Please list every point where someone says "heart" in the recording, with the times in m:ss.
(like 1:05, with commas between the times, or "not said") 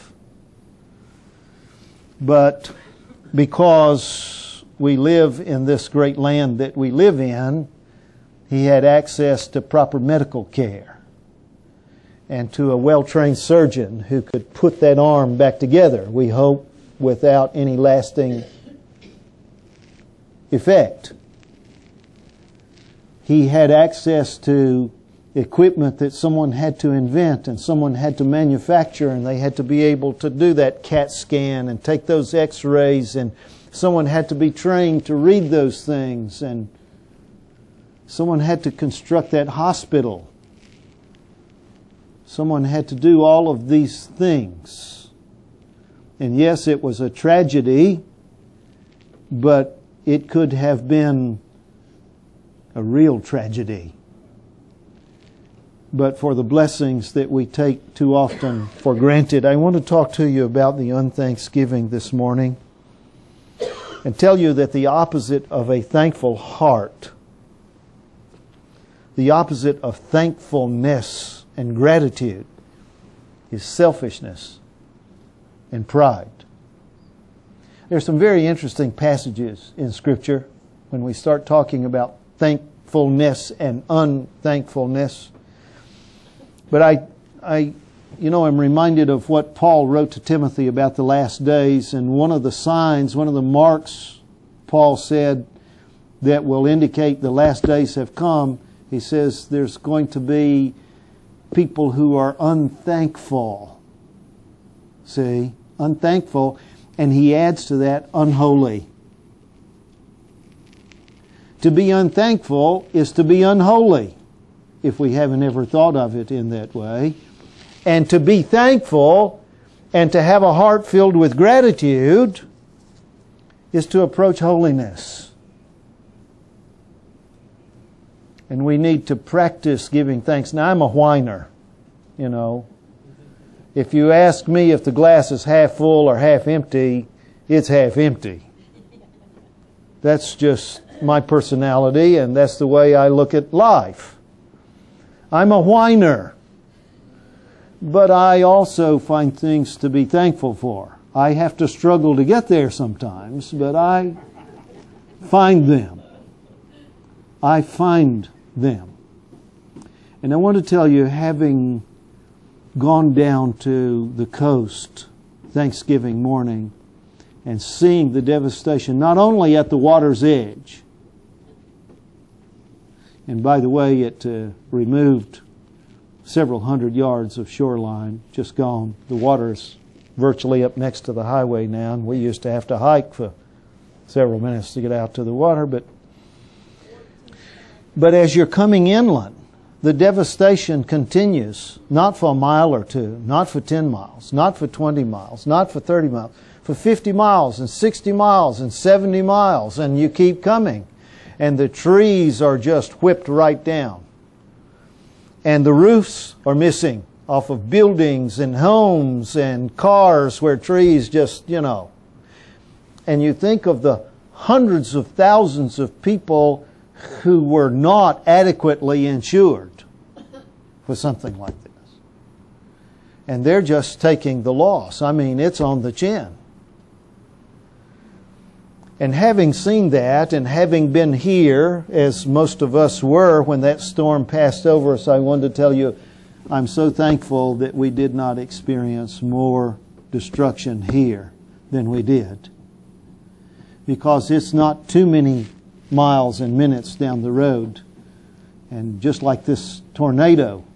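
1:06, 2:00.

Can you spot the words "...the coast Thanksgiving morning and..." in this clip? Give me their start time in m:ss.
2:44.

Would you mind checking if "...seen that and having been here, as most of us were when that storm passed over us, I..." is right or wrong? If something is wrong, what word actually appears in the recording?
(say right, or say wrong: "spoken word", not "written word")
right.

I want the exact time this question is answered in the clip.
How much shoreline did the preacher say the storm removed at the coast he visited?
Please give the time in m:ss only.
2:56.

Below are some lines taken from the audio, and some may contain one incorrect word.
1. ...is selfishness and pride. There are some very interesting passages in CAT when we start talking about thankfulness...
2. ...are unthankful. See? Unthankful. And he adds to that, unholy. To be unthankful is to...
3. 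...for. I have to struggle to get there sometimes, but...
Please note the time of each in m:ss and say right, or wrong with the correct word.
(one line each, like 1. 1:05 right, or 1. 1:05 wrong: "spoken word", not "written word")
1. 1:13 wrong: "Scripture", not "CAT"
2. 1:42 right
3. 2:30 right.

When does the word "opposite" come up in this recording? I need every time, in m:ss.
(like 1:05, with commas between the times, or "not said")
1:04, 1:09.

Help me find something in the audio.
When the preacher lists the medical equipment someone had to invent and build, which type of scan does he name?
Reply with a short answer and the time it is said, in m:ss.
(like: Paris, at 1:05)
CAT scan, at 0:30.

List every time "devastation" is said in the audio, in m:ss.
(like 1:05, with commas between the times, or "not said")
2:48, 3:09.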